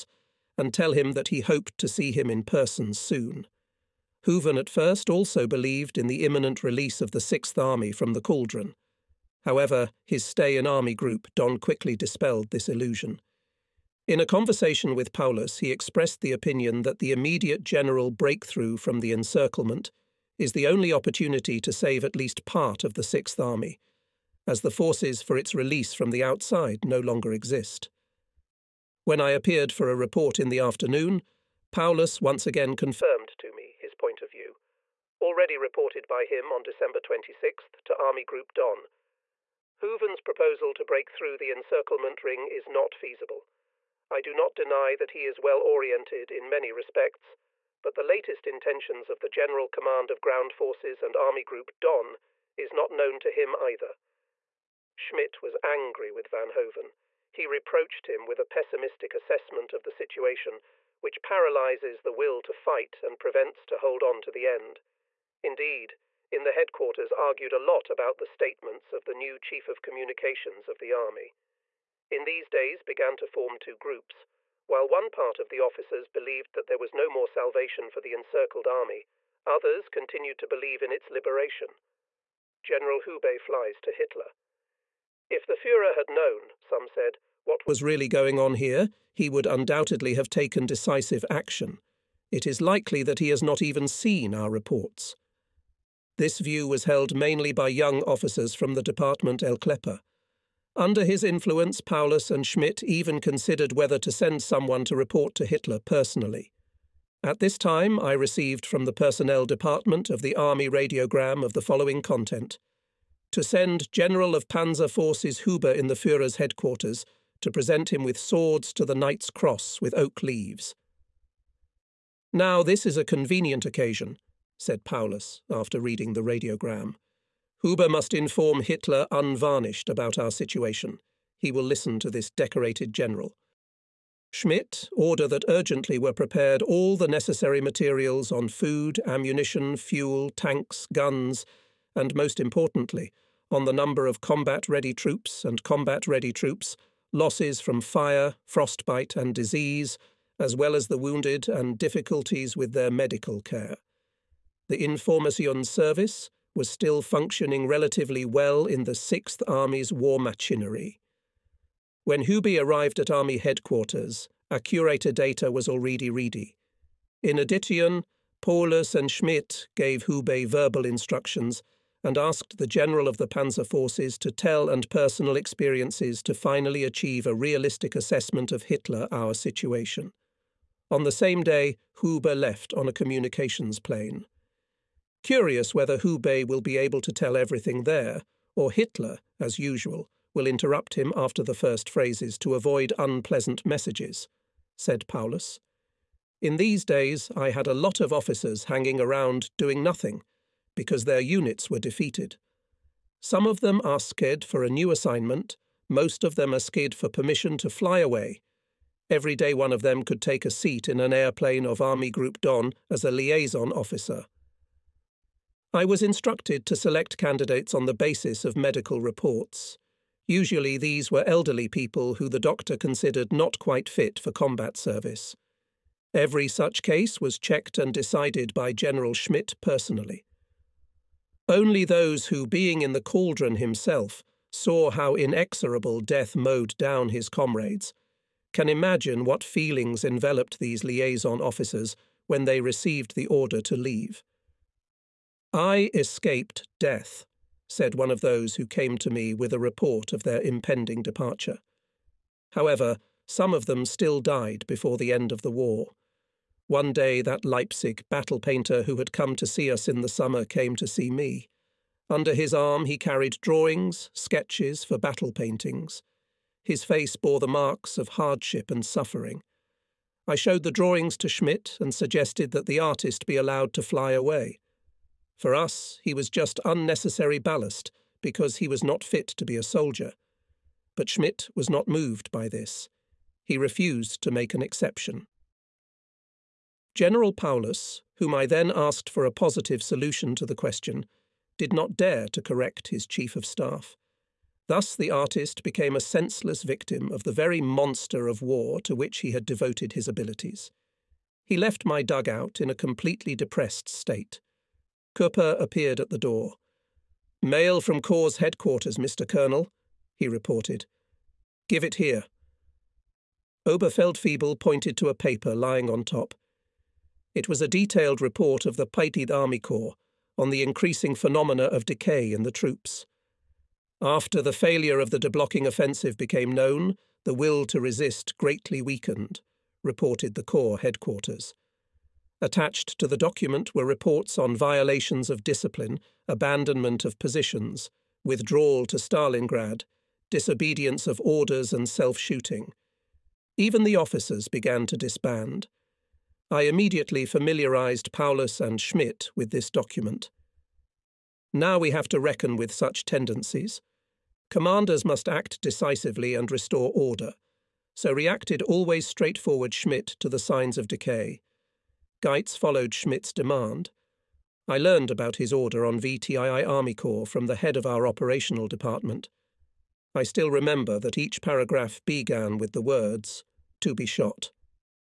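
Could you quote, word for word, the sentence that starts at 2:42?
When Hube arrived at Army headquarters, curator data was already ready.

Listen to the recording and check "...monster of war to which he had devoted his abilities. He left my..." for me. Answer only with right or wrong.
right.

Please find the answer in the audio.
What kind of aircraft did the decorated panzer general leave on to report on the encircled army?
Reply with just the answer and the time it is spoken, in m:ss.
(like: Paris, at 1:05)
communications plane, at 3:02.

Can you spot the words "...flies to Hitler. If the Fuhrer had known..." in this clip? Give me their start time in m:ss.
1:23.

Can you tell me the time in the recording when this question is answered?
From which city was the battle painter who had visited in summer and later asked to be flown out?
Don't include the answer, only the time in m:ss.
4:17.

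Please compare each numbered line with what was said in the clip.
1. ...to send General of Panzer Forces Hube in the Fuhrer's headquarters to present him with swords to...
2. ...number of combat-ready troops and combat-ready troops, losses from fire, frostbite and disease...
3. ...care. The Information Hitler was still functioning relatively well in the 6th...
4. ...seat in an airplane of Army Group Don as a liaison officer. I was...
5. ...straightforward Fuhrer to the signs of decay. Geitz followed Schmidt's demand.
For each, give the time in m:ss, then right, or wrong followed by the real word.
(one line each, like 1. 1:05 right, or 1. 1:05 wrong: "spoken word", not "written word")
1. 1:53 right
2. 2:23 right
3. 2:33 wrong: "Service", not "Hitler"
4. 3:30 right
5. 5:59 wrong: "Schmidt", not "Fuhrer".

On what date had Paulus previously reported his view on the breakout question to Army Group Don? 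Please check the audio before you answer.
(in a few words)
December 26th.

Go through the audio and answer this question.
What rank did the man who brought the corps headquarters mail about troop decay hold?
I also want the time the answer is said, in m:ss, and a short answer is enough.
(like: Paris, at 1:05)
Oberfeldwebel, at 5:13.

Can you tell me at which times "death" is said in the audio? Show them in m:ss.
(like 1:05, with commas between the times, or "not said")
3:56, 4:06.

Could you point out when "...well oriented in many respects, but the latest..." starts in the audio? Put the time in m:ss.
0:45.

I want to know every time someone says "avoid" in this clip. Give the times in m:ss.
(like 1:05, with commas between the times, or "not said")
3:12.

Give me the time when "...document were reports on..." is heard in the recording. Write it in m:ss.
5:33.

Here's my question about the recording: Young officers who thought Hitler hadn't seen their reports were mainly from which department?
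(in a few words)
Department El Klepper.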